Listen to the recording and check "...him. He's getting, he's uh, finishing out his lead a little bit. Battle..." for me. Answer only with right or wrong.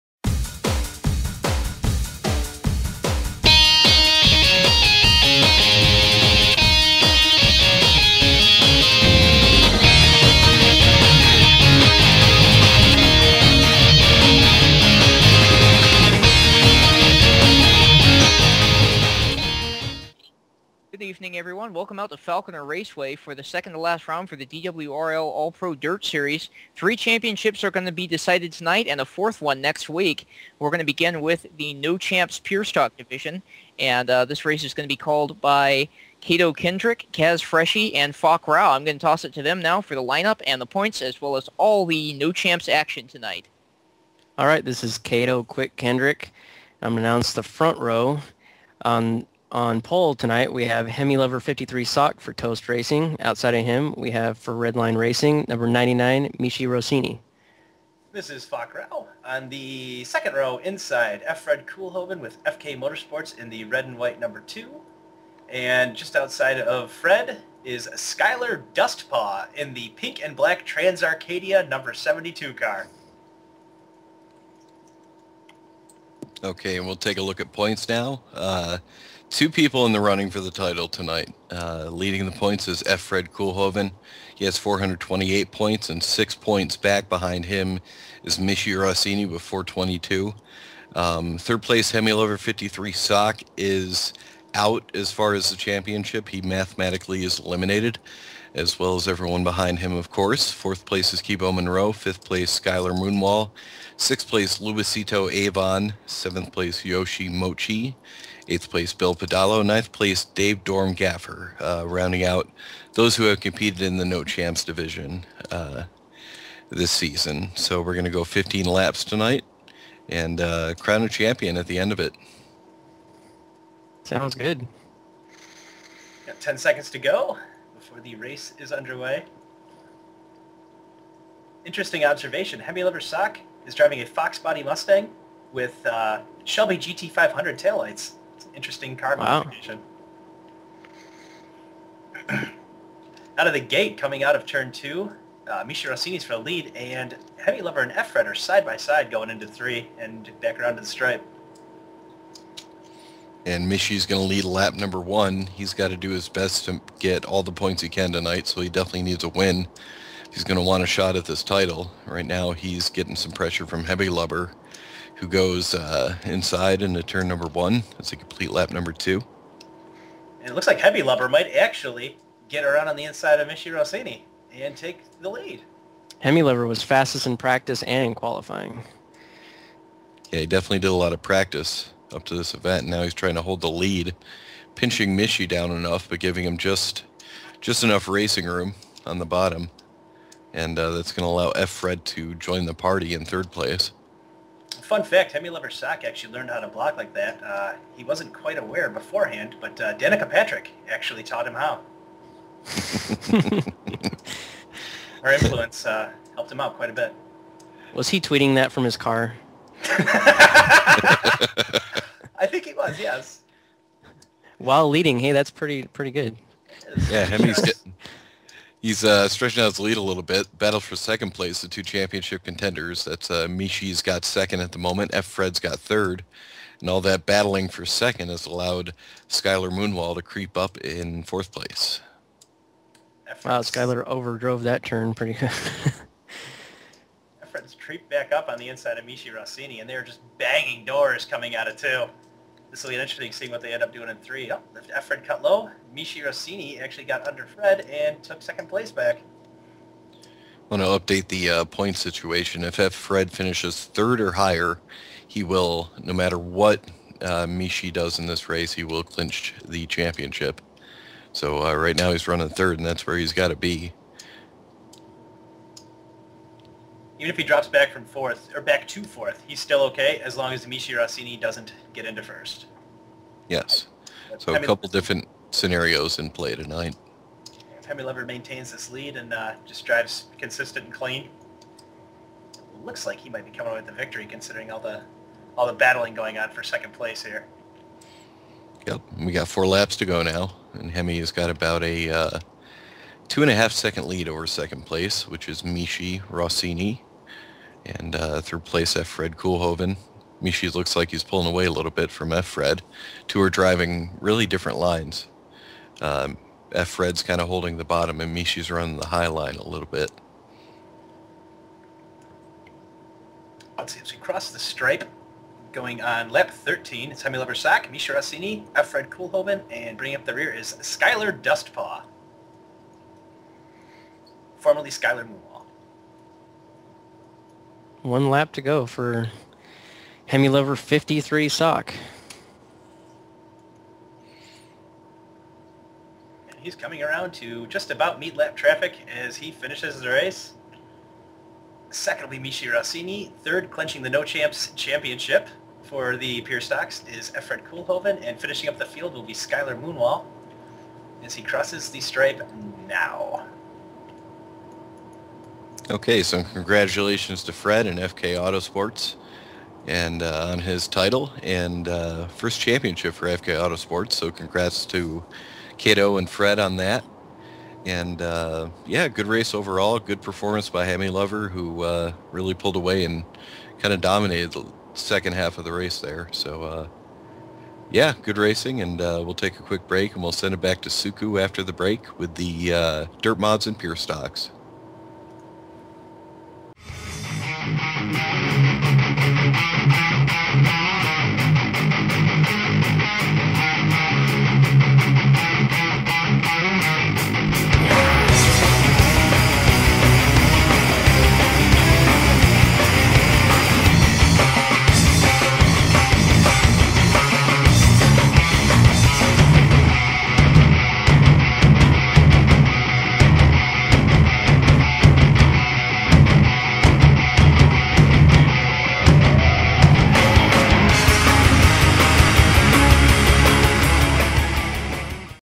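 wrong.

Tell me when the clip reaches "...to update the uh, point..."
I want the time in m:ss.
4:10.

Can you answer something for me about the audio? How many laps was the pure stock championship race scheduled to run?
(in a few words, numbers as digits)
15.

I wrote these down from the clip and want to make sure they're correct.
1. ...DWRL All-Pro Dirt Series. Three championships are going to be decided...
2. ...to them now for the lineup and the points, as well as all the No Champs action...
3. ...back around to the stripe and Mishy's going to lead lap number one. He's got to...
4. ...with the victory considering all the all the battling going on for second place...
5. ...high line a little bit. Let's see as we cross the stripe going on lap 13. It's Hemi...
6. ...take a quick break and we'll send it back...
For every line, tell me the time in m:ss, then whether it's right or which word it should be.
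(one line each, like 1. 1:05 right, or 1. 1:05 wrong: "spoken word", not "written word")
1. 0:24 right
2. 0:39 right
3. 2:30 right
4. 4:43 right
5. 5:09 right
6. 6:19 right.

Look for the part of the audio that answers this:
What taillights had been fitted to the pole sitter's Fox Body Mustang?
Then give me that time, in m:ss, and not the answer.
2:16.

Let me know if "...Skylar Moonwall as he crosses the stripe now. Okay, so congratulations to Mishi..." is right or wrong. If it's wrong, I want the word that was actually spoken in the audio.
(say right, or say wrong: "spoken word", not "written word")
wrong: "Fred", not "Mishi".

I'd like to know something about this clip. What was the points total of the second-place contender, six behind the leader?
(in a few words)
422.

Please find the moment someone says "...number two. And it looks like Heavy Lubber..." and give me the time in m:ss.
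2:48.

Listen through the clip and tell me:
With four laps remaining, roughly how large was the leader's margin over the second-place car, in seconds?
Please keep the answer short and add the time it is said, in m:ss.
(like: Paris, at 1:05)
2.5 seconds, at 4:53.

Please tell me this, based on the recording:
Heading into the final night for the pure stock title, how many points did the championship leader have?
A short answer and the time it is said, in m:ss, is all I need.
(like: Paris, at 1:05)
428, at 1:24.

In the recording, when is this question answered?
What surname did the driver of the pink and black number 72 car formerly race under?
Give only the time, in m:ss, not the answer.
5:24.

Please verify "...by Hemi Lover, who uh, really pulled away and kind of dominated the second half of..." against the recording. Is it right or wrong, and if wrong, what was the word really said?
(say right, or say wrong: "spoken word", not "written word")
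right.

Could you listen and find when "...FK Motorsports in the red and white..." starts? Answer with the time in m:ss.
1:02.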